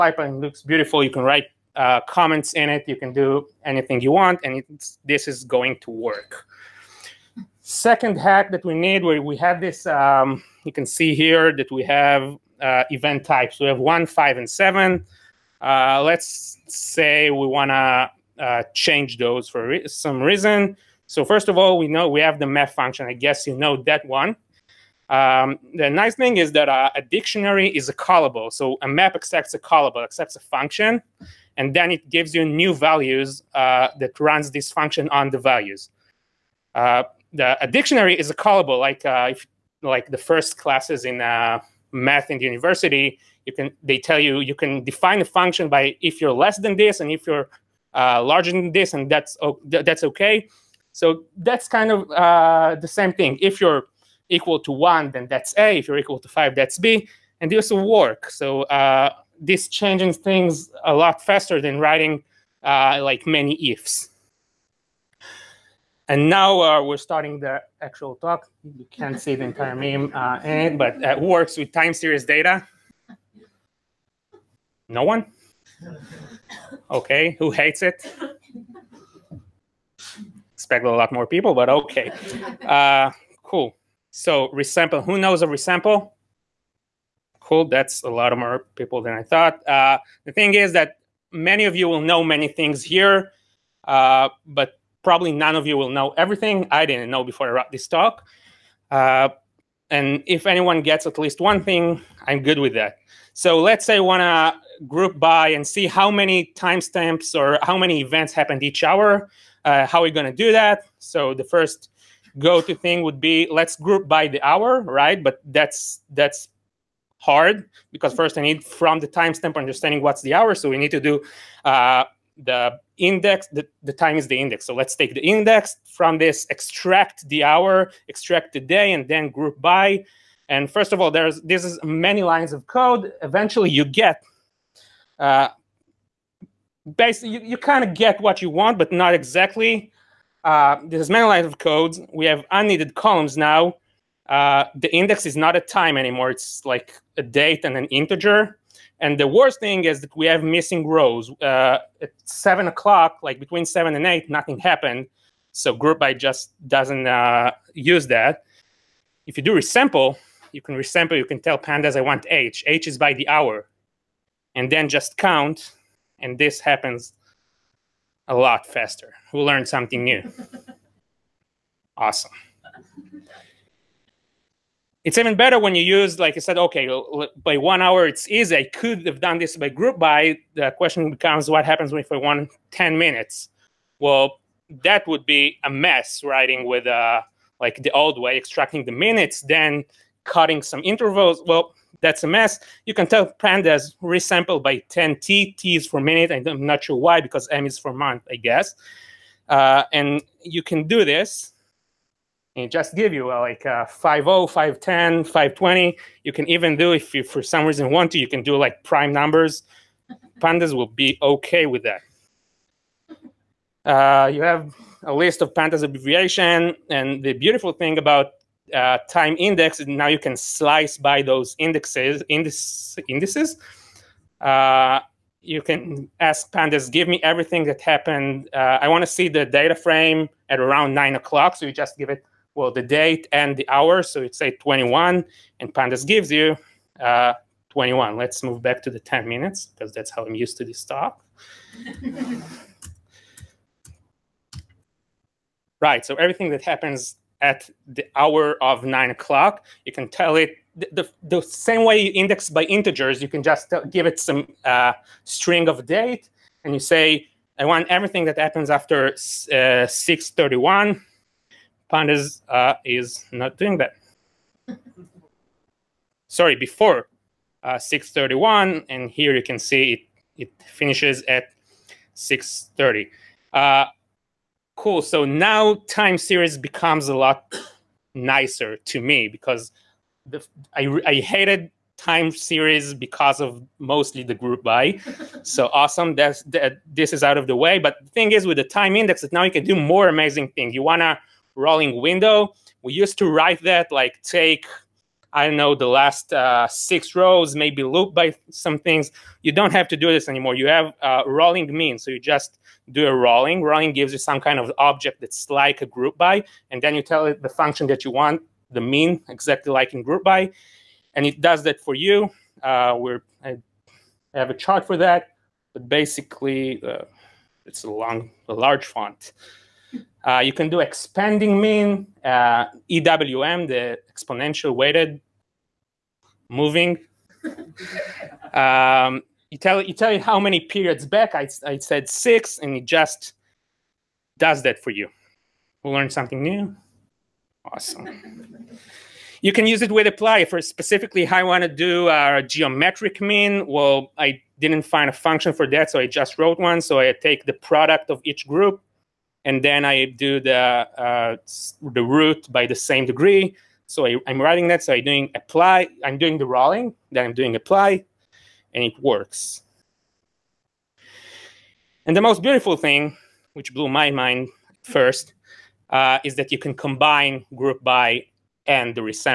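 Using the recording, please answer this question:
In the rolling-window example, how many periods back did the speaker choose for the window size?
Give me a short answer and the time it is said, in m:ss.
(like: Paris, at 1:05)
6, at 5:31.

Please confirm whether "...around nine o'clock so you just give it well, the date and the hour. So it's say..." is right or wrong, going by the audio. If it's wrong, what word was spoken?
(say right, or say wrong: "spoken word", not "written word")
right.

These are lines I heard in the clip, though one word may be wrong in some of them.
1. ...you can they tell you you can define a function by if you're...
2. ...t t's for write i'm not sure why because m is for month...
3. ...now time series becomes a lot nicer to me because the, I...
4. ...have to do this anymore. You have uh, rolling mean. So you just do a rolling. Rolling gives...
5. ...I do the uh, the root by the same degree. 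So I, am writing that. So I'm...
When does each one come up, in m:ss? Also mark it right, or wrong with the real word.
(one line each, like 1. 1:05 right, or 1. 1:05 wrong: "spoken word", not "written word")
1. 0:43 right
2. 3:15 wrong: "minute", not "write"
3. 4:35 right
4. 4:59 right
5. 5:49 right.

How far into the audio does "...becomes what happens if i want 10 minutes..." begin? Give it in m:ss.
3:01.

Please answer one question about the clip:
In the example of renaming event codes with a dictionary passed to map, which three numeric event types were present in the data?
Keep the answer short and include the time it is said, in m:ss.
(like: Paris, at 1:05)
1, 5, and 7, at 0:13.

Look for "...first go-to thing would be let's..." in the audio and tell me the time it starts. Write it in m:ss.
1:51.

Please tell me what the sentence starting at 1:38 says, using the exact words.
Uh, and if anyone gets at least one thing, I'm good with that.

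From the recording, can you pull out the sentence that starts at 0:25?
Um, the nice thing is that uh, a dictionary is a callable.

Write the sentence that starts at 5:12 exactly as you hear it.
Uh, we're I have a chart for that, but basically uh, it's a long, a large font.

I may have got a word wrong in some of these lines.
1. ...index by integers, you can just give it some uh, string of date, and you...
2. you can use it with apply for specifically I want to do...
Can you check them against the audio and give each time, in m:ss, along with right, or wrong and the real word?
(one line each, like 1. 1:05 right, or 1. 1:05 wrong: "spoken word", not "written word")
1. 4:12 right
2. 5:39 right.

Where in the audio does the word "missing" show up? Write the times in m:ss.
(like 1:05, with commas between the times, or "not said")
2:30.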